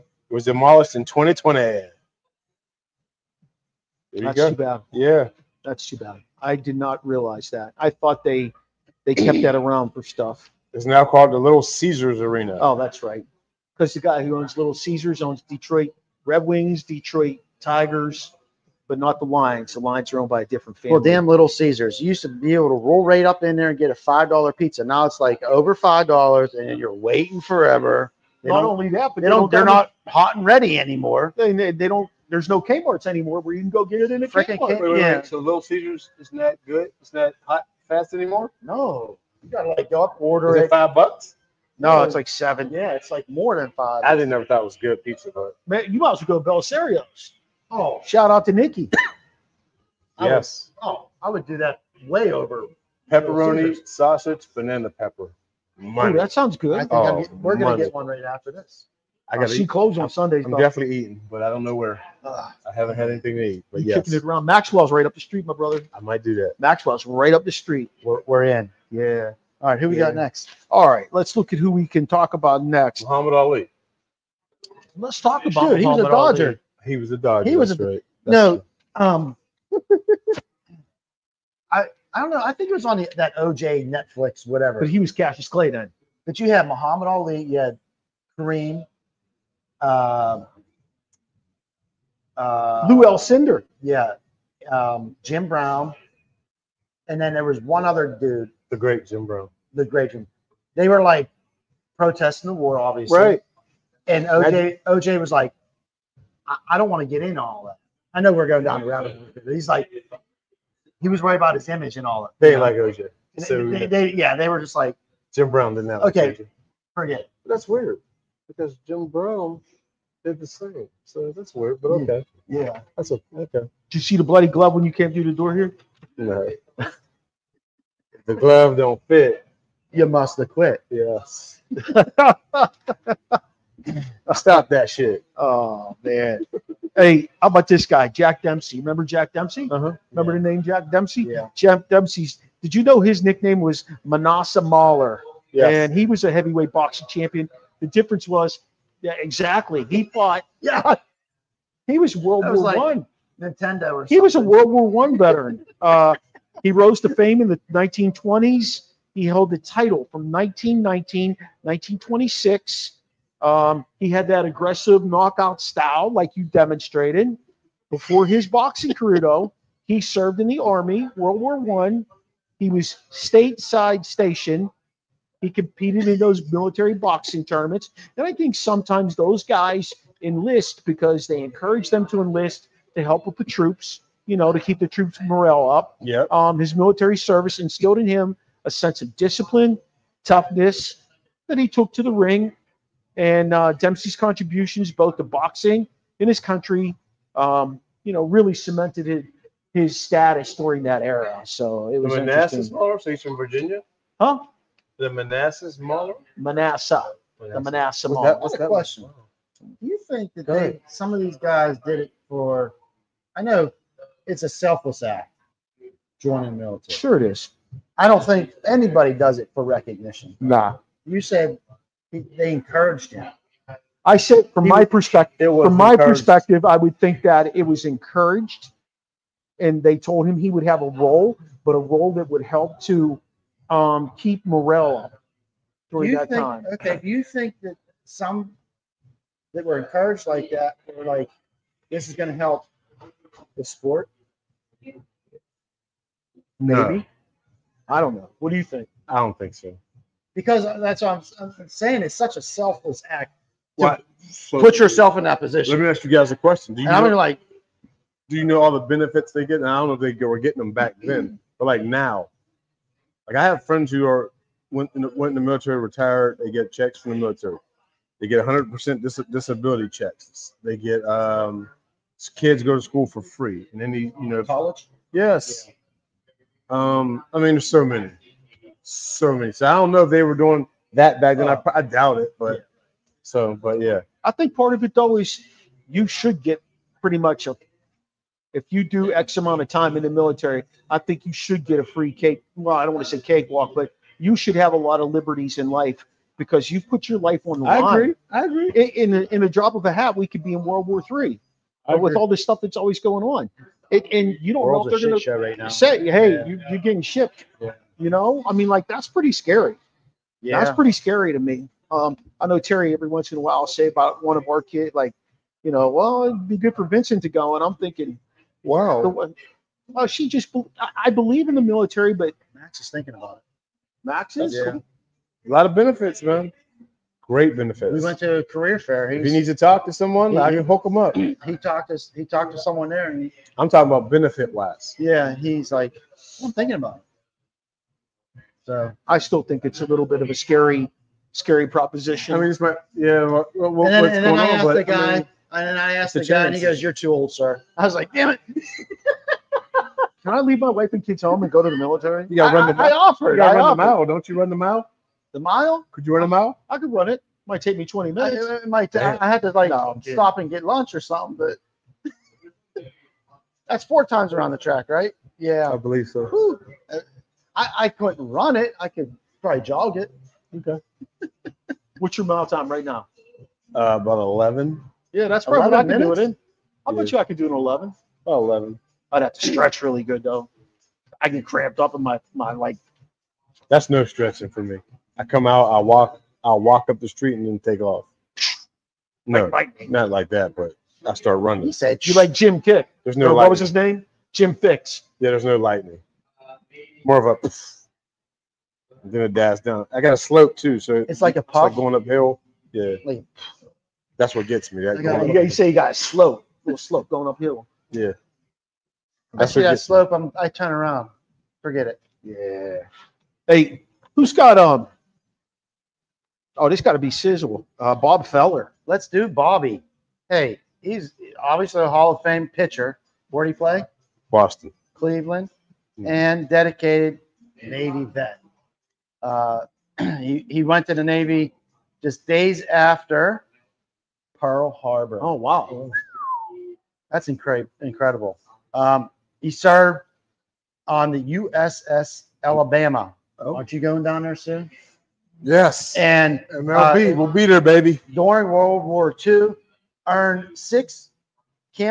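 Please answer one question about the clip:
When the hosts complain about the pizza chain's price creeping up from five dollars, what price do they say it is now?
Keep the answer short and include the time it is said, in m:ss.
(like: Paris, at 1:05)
7, at 0:42.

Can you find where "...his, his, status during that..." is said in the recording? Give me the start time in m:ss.
3:19.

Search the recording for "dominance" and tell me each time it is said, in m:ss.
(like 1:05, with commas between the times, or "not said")
not said.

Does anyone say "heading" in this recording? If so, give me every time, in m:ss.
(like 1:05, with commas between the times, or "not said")
not said.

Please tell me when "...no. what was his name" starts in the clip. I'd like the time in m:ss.
6:33.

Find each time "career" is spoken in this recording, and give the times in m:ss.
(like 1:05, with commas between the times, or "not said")
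2:48, 5:28.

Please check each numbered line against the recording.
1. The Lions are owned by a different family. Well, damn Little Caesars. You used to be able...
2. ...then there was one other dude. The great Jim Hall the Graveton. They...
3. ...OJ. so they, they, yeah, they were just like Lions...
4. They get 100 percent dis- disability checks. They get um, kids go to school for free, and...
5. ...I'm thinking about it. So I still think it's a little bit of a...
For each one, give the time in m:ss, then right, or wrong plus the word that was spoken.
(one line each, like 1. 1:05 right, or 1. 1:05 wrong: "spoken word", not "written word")
1. 0:19 right
2. 1:37 wrong: "Brown", not "Hall"
3. 1:52 wrong: "Jim", not "Lions"
4. 4:28 right
5. 5:36 right.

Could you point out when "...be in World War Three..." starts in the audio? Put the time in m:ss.
5:00.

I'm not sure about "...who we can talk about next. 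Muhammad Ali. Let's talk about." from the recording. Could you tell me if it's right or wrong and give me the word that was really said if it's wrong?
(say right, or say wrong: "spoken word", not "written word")
right.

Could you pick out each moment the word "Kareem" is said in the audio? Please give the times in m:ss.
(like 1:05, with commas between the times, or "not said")
1:28.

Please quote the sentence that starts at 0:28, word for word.
They not only that, but they, they don't.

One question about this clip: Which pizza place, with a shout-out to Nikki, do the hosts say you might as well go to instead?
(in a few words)
Belisario's.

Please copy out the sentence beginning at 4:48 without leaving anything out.
If you do X amount of time in the military, I think you should get a free cake.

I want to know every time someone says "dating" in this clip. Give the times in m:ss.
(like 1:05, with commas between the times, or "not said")
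not said.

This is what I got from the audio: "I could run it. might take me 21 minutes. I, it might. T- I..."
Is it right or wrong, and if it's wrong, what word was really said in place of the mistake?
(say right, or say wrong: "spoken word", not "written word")
wrong: "20", not "21".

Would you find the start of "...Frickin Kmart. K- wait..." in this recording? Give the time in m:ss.
0:34.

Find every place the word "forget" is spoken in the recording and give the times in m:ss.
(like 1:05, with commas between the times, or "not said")
1:56, 6:51.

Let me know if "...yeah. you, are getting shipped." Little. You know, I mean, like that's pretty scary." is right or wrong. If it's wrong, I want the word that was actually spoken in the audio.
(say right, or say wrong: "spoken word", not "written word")
wrong: "Yeah", not "Little".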